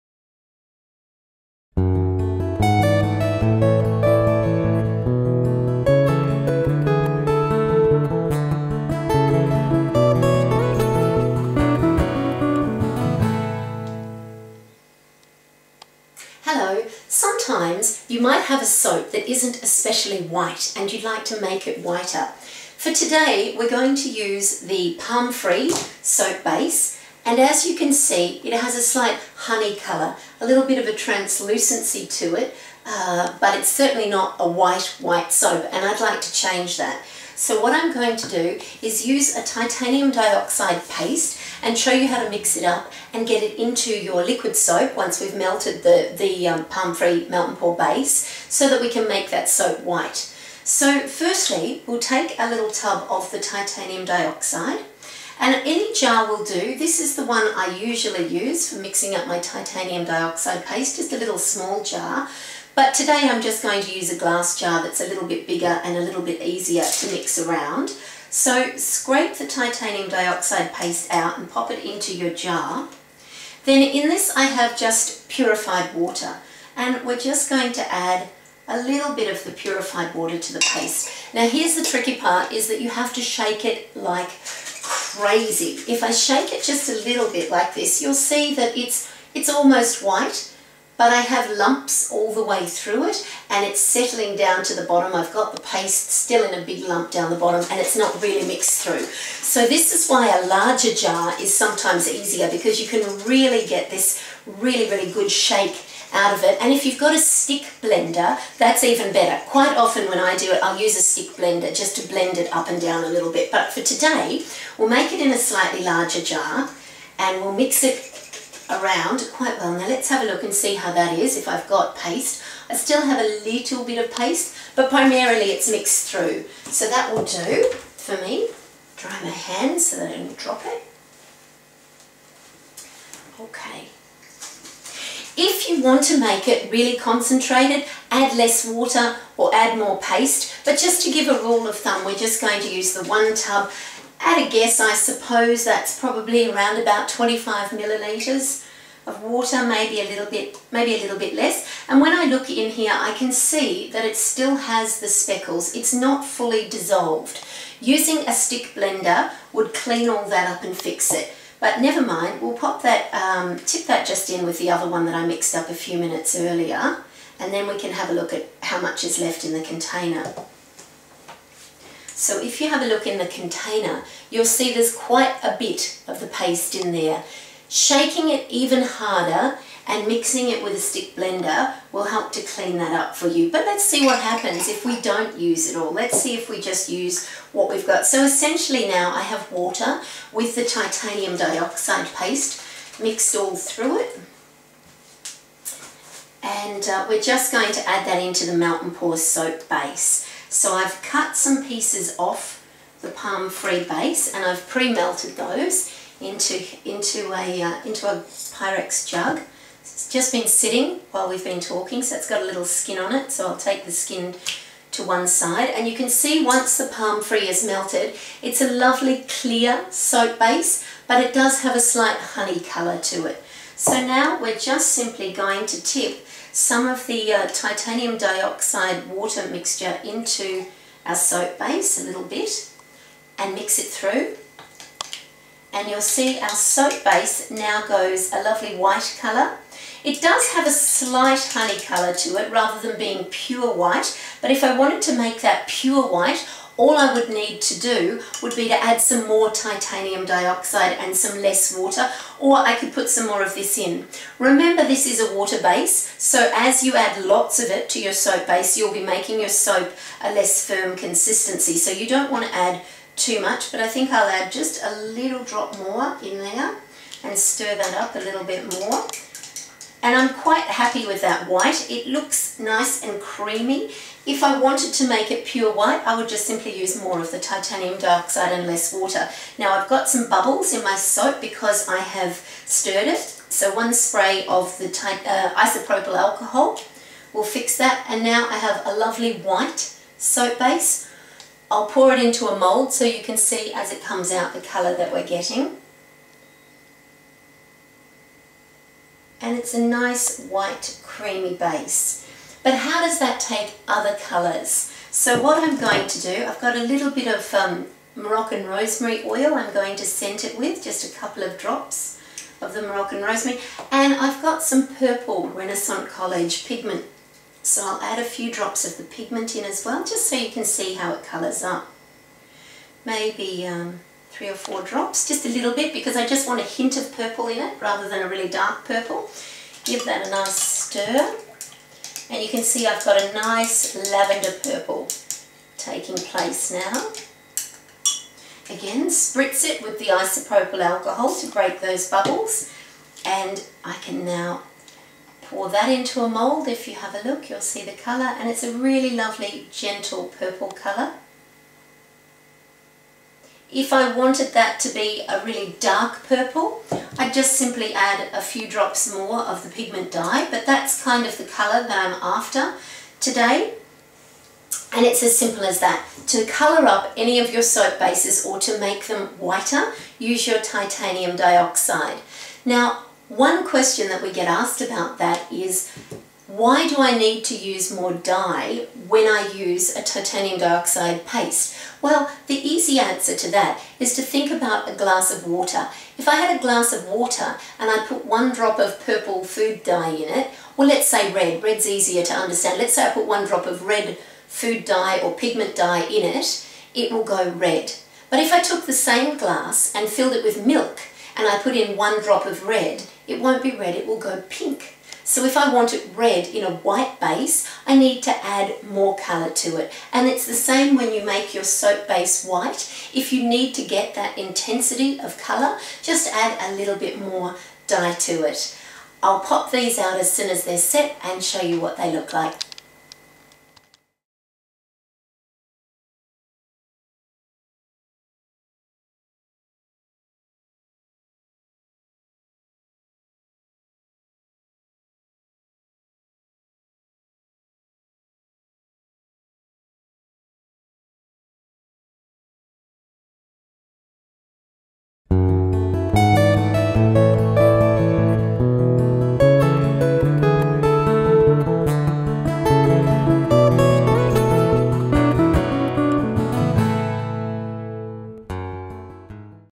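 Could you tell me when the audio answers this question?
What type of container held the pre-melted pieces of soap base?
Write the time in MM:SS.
03:28.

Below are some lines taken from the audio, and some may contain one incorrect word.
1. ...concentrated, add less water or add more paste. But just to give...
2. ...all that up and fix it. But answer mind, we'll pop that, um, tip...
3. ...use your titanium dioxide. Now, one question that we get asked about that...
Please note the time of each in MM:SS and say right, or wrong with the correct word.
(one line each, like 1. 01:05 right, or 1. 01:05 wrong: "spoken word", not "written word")
1. 02:16 right
2. 02:40 wrong: "never", not "answer"
3. 06:10 right.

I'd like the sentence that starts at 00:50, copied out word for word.
So firstly, we'll take a little tub of the titanium dioxide and any jar will do.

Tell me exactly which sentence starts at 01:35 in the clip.
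I've got the paste still in a big lump down the bottom and it's not really mixed through.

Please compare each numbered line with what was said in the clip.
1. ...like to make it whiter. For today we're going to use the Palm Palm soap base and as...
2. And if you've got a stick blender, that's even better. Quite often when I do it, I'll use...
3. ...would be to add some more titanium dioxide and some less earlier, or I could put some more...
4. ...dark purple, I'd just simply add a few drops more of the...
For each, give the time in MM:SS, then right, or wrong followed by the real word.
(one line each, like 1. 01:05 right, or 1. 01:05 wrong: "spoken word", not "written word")
1. 00:21 wrong: "Free", not "Palm"
2. 01:46 right
3. 04:08 wrong: "water", not "earlier"
4. 05:55 right.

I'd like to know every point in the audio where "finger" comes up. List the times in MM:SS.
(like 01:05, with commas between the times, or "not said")
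not said.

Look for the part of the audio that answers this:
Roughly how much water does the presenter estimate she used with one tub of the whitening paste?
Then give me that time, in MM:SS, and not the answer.
02:27.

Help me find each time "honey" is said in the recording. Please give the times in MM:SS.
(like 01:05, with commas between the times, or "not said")
00:29, 03:42, 04:01.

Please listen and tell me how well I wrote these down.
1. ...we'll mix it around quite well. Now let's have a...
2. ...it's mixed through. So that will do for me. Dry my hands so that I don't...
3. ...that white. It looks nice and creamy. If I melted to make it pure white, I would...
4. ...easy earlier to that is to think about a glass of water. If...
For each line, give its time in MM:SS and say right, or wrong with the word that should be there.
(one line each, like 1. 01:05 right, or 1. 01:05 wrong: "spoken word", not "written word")
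1. 01:57 right
2. 02:05 right
3. 04:31 wrong: "wanted", not "melted"
4. 06:22 wrong: "answer", not "earlier".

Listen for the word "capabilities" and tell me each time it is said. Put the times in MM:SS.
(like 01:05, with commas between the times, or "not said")
not said.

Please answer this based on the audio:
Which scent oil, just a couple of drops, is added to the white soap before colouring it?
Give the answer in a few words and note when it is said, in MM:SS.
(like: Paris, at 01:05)
Moroccan rosemary oil, at 05:08.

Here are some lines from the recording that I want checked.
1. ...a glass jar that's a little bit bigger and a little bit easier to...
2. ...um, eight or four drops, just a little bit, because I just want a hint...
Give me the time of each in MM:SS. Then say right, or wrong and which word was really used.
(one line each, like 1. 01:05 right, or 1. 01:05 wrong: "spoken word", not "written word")
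1. 01:04 right
2. 05:23 wrong: "three", not "eight".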